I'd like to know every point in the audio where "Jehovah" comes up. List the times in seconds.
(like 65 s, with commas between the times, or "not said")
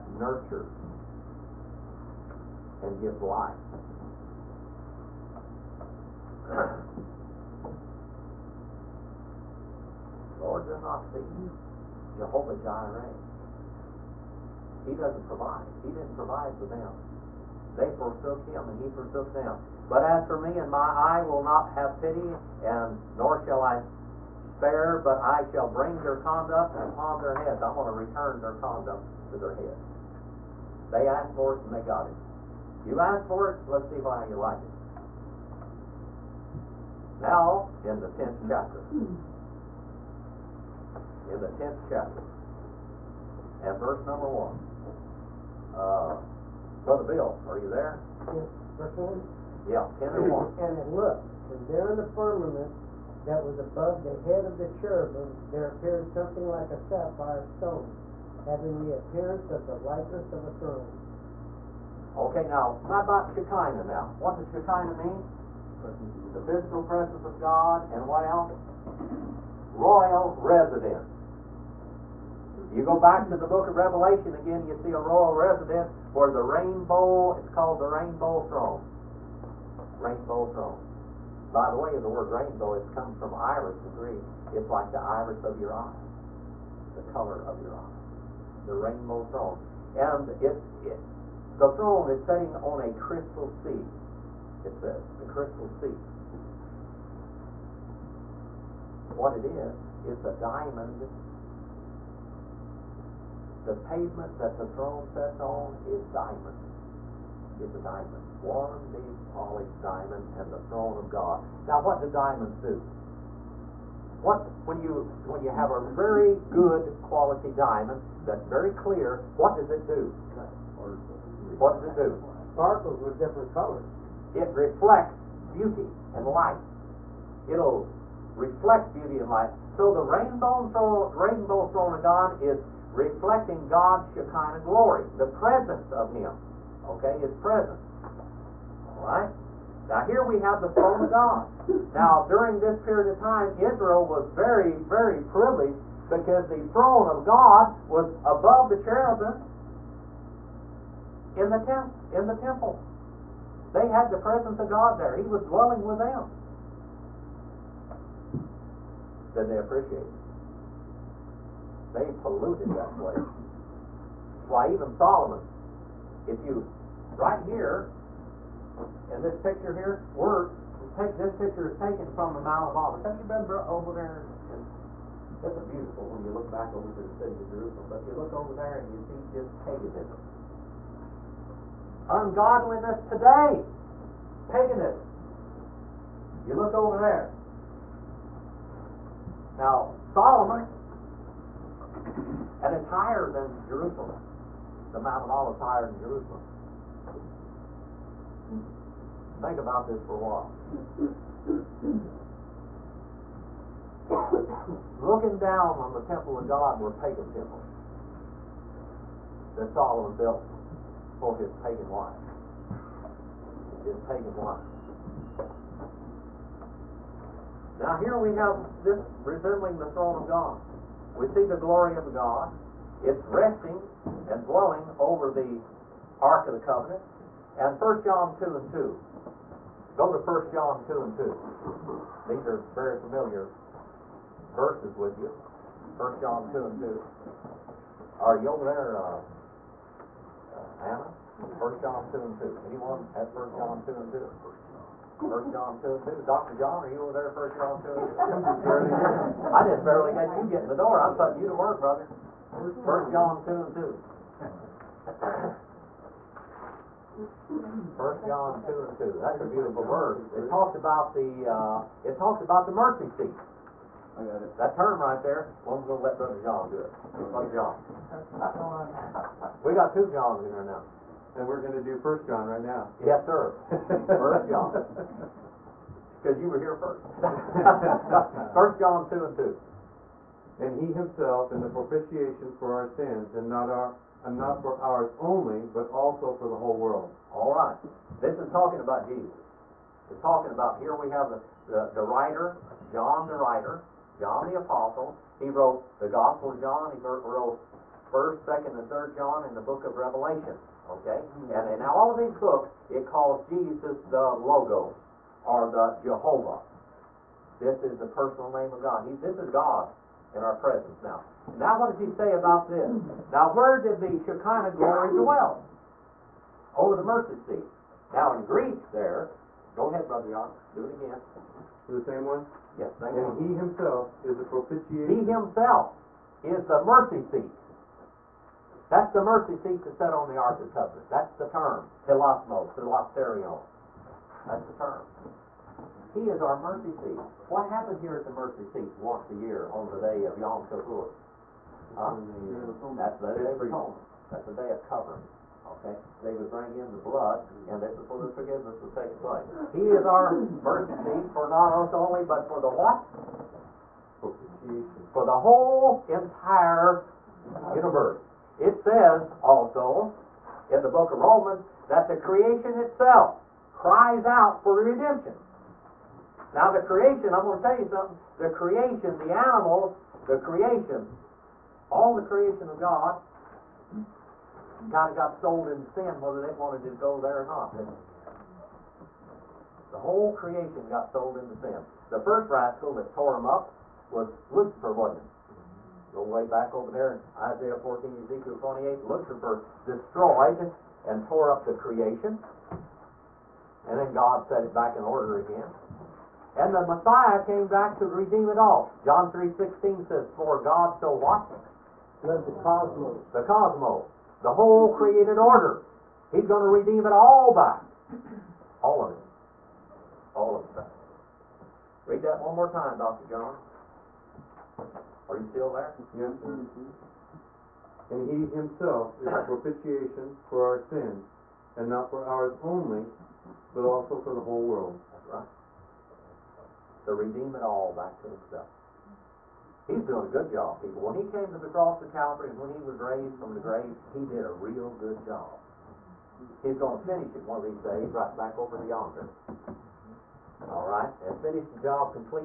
12 s, 306 s.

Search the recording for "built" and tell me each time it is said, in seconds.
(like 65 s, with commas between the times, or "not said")
210 s.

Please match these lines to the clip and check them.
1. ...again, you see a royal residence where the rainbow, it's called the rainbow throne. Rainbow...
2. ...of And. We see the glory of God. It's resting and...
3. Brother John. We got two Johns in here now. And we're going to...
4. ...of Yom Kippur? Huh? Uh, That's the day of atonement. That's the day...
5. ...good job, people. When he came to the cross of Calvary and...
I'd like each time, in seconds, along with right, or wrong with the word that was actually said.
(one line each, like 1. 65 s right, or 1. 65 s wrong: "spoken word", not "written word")
1. 74 s right
2. 220 s wrong: "God", not "And"
3. 267 s right
4. 340 s right
5. 430 s right.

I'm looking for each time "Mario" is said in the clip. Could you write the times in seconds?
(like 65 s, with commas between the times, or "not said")
not said.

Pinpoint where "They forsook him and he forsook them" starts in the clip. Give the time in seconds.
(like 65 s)
17 s.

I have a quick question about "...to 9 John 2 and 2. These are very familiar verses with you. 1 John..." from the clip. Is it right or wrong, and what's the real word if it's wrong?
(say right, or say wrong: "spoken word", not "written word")
wrong: "1", not "9".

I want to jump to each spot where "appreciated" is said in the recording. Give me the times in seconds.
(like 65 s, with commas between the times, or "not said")
159 s.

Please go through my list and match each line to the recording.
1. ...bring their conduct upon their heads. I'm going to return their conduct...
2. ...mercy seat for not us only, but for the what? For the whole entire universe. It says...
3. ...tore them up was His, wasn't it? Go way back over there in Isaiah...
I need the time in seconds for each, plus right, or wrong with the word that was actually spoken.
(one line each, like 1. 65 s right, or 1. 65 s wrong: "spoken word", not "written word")
1. 25 s right
2. 350 s right
3. 383 s wrong: "Lucifer", not "His".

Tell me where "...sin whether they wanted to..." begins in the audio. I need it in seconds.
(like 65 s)
375 s.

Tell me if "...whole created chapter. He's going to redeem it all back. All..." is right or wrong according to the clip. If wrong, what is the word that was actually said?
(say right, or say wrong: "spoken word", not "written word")
wrong: "order", not "chapter".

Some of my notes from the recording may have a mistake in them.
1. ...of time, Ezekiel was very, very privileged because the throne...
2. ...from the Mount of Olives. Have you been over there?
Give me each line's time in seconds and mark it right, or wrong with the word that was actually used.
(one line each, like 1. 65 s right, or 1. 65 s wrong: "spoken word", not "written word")
1. 143 s wrong: "Israel", not "Ezekiel"
2. 172 s right.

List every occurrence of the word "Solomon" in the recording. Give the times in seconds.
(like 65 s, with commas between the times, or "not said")
164 s, 190 s, 209 s.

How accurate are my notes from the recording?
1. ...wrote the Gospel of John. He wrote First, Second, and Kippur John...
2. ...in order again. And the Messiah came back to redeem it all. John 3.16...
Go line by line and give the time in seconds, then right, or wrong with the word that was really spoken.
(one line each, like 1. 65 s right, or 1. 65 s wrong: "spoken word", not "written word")
1. 295 s wrong: "Third", not "Kippur"
2. 394 s right.